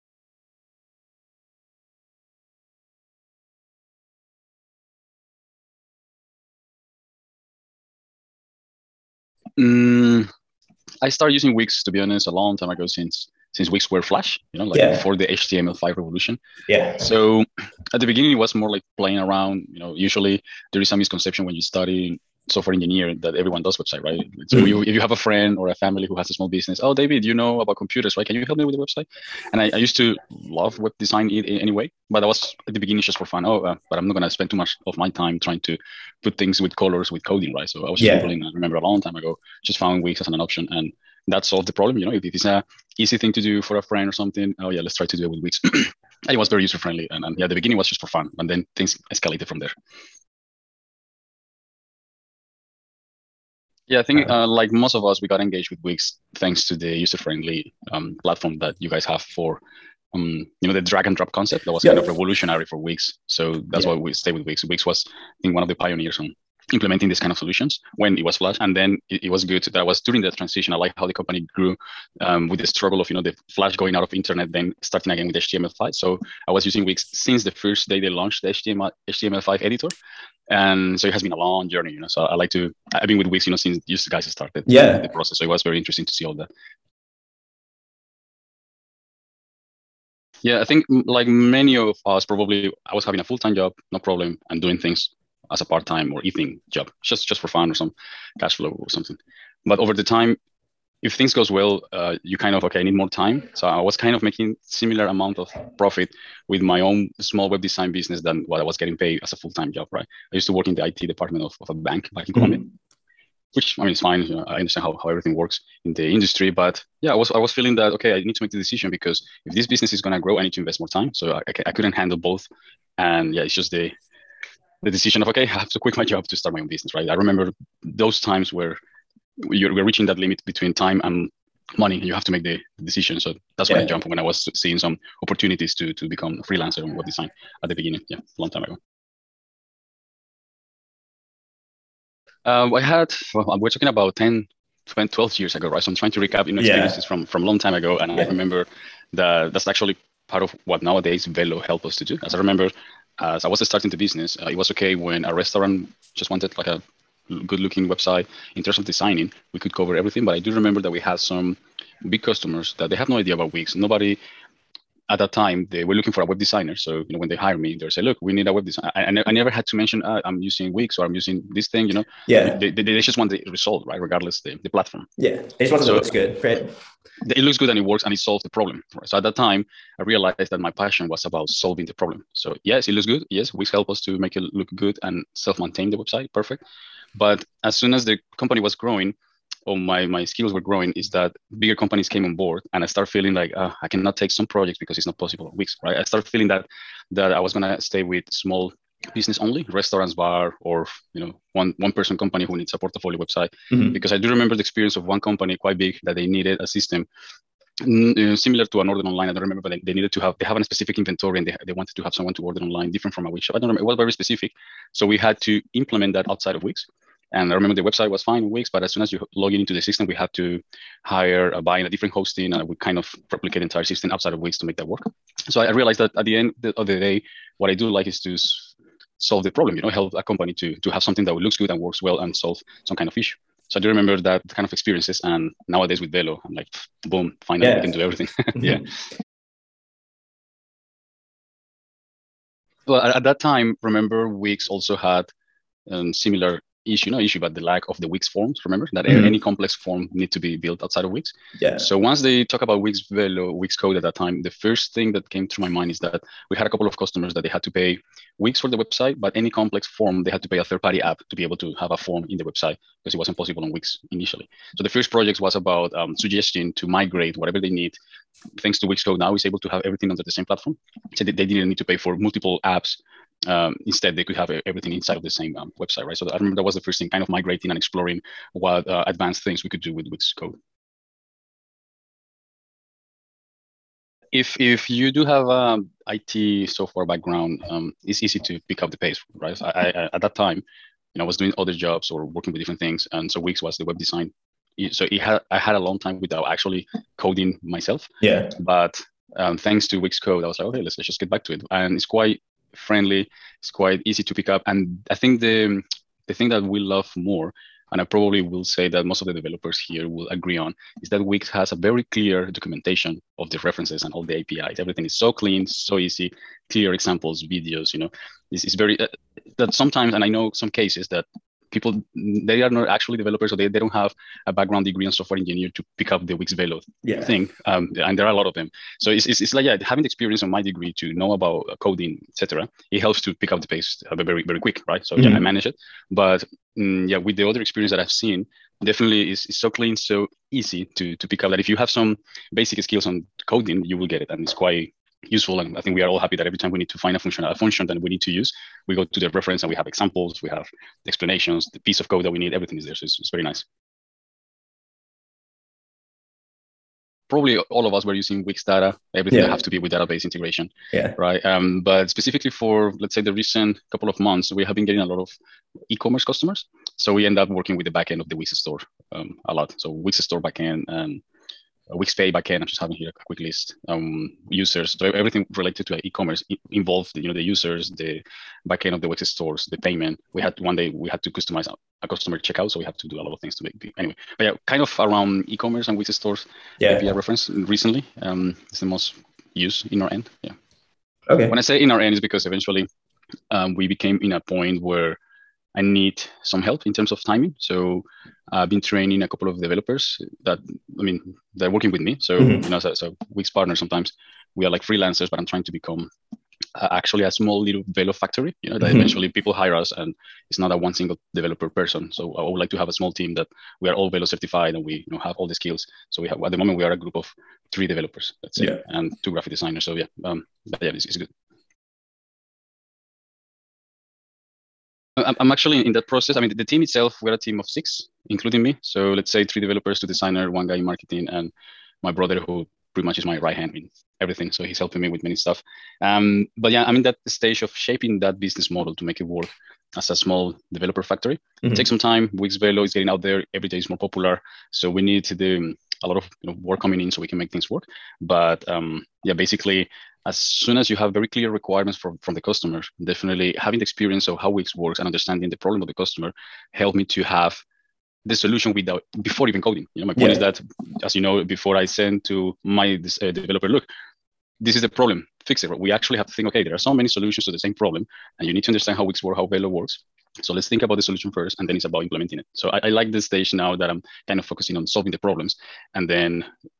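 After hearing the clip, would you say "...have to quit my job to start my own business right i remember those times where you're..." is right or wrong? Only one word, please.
right.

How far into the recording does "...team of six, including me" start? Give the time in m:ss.
7:07.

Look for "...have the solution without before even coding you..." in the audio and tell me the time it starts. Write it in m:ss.
7:37.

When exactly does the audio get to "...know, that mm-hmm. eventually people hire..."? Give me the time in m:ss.
6:48.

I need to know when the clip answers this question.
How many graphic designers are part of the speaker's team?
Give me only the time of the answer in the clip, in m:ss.
6:59.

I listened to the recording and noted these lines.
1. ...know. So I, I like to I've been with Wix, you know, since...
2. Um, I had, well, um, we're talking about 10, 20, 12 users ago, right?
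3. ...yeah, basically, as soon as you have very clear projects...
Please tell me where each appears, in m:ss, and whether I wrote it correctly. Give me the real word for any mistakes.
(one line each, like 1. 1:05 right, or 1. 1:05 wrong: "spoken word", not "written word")
1. 1:21 right
2. 2:22 wrong: "years", not "users"
3. 7:29 wrong: "requirements", not "projects".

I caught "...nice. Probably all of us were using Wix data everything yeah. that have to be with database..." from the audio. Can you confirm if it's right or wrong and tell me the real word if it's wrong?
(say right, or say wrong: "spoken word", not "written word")
right.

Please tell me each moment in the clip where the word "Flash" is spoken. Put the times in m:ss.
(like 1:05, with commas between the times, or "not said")
0:14, 1:08, 1:13.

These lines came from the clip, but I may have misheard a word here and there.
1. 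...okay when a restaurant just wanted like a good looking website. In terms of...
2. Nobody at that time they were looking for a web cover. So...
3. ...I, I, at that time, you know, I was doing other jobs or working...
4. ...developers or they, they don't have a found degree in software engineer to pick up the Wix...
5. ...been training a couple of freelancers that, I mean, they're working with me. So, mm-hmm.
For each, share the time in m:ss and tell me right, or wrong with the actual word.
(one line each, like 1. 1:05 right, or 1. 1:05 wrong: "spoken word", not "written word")
1. 2:34 right
2. 2:43 wrong: "designer", not "cover"
3. 4:49 right
4. 5:23 wrong: "background", not "found"
5. 6:38 wrong: "developers", not "freelancers".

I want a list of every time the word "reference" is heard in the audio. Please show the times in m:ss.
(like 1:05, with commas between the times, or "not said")
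5:13, 5:49, 6:27.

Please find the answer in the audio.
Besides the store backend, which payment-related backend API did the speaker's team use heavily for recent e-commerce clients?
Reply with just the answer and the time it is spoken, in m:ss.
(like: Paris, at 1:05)
Wix Pay backend, at 6:11.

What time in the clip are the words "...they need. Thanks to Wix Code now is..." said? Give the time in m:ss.
4:27.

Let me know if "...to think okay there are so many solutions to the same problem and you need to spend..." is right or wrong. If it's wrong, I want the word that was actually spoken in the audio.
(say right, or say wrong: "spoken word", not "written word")
wrong: "understand", not "spend".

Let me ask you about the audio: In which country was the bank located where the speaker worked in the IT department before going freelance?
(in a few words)
Colombia.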